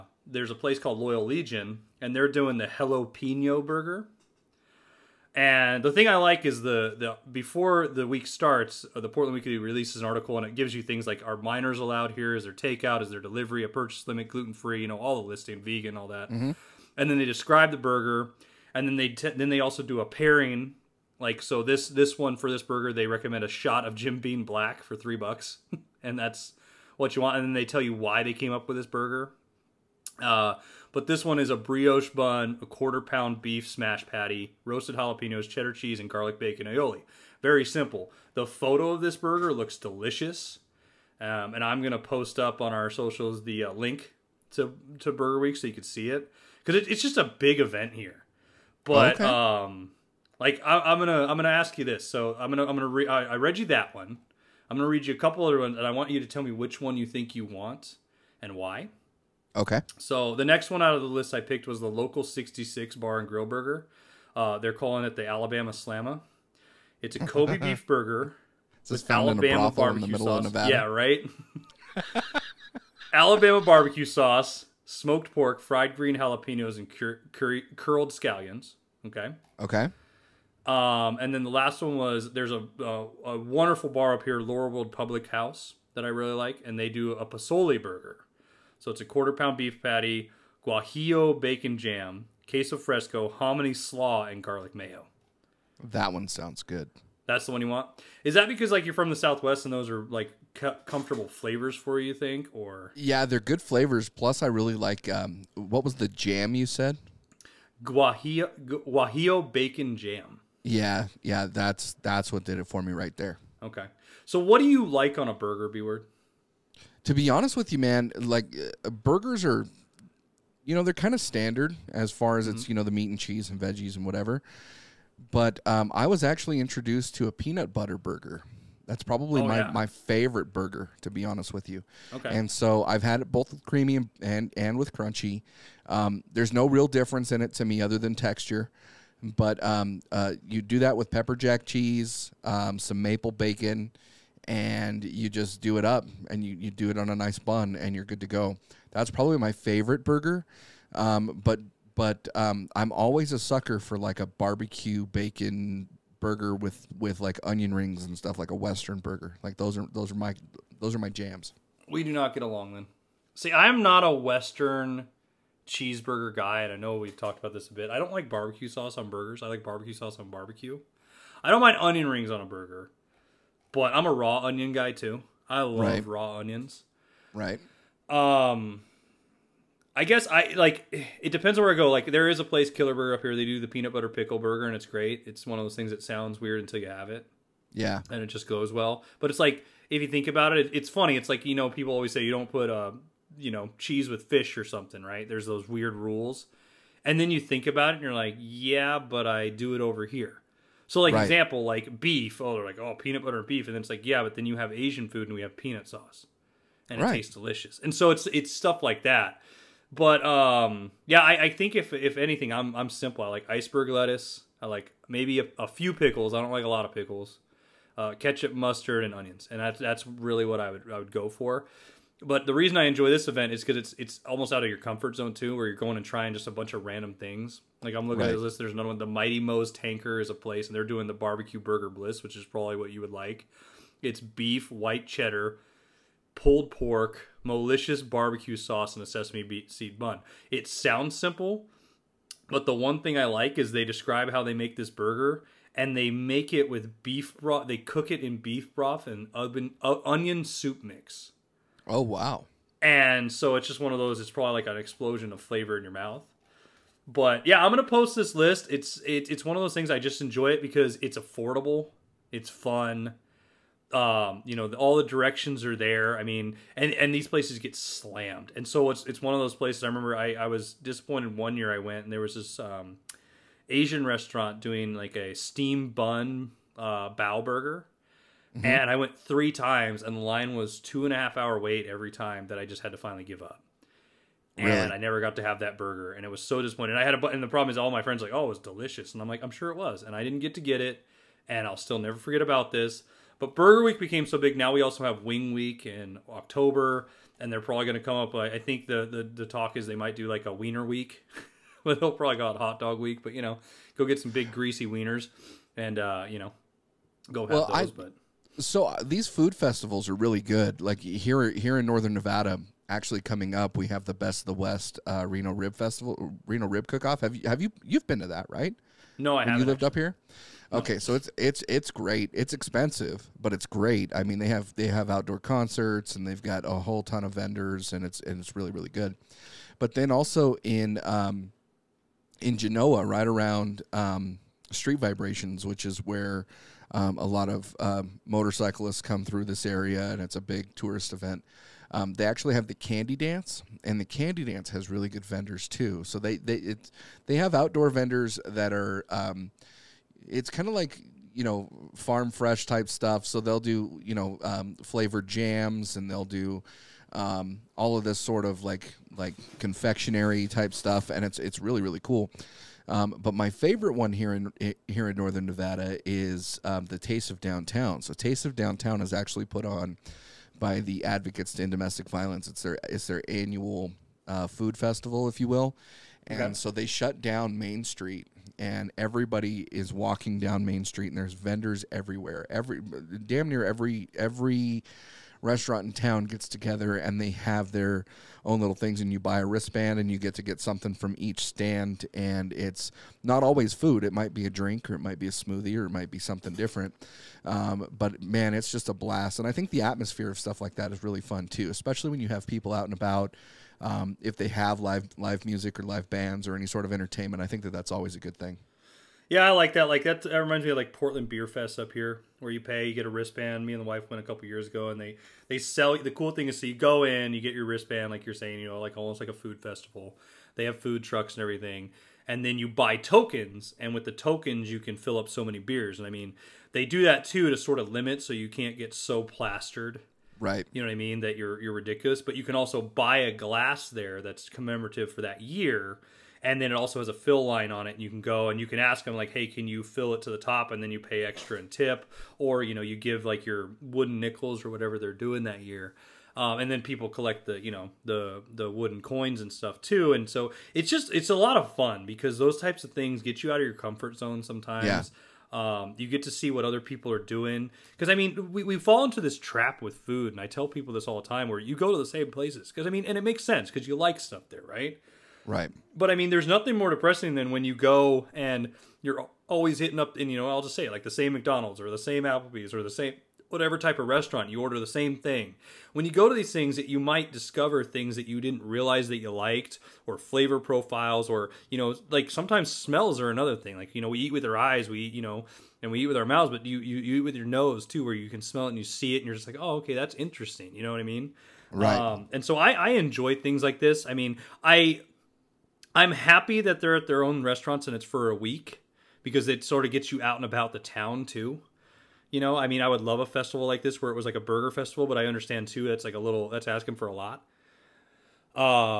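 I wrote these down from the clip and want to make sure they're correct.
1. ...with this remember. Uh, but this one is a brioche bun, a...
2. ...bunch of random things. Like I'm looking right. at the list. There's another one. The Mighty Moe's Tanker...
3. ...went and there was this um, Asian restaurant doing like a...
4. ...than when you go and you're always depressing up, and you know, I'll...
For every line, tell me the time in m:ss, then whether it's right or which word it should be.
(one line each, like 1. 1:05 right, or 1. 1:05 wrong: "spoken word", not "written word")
1. 0:28 wrong: "burger", not "remember"
2. 3:46 right
3. 4:31 right
4. 7:47 wrong: "hitting", not "depressing".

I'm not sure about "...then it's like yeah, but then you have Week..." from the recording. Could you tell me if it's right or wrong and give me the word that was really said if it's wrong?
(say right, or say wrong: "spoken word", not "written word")
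wrong: "Asian", not "Week".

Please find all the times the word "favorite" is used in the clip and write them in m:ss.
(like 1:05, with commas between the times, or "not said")
2:09, 2:29, 6:03.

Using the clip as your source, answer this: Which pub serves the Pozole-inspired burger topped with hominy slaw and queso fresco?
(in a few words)
Laurelwood Public House.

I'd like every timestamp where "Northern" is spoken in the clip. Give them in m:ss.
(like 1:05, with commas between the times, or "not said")
5:11, 6:05.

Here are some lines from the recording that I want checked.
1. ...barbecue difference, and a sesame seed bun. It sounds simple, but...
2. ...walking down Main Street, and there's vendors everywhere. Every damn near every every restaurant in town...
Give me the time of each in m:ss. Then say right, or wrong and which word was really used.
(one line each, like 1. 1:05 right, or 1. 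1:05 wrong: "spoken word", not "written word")
1. 3:58 wrong: "sauce", not "difference"
2. 6:19 right.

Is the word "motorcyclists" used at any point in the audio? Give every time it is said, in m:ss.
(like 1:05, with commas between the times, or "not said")
5:38.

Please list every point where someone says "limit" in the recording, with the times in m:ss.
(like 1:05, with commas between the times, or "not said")
0:14, 7:07.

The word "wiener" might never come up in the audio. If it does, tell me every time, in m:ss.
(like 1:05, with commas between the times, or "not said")
5:00, 5:04.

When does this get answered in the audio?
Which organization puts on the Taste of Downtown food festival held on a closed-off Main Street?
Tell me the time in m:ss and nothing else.
6:11.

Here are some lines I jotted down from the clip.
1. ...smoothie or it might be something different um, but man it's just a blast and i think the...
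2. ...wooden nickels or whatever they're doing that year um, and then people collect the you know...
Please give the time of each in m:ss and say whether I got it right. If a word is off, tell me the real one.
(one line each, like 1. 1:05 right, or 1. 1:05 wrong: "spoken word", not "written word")
1. 6:35 right
2. 7:23 right.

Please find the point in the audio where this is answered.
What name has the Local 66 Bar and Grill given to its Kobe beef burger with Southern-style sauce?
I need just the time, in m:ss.
1:05.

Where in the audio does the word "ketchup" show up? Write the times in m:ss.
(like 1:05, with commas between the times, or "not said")
3:38.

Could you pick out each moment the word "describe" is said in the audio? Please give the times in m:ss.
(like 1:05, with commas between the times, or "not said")
0:17, 4:03.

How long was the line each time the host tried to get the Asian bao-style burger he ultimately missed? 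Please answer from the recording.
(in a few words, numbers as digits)
2.5 hours.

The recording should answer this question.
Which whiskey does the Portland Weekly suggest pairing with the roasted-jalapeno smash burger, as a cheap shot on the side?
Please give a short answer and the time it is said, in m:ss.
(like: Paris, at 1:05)
Jim Beam Black, at 0:23.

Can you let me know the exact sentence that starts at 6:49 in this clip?
Like that, that reminds me of like Portland Beer Fest up here, where you pay, you get a wristband.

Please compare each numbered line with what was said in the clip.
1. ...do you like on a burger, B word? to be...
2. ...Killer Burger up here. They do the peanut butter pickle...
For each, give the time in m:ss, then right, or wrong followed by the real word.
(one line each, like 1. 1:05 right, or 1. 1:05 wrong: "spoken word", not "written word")
1. 1:54 right
2. 3:02 right.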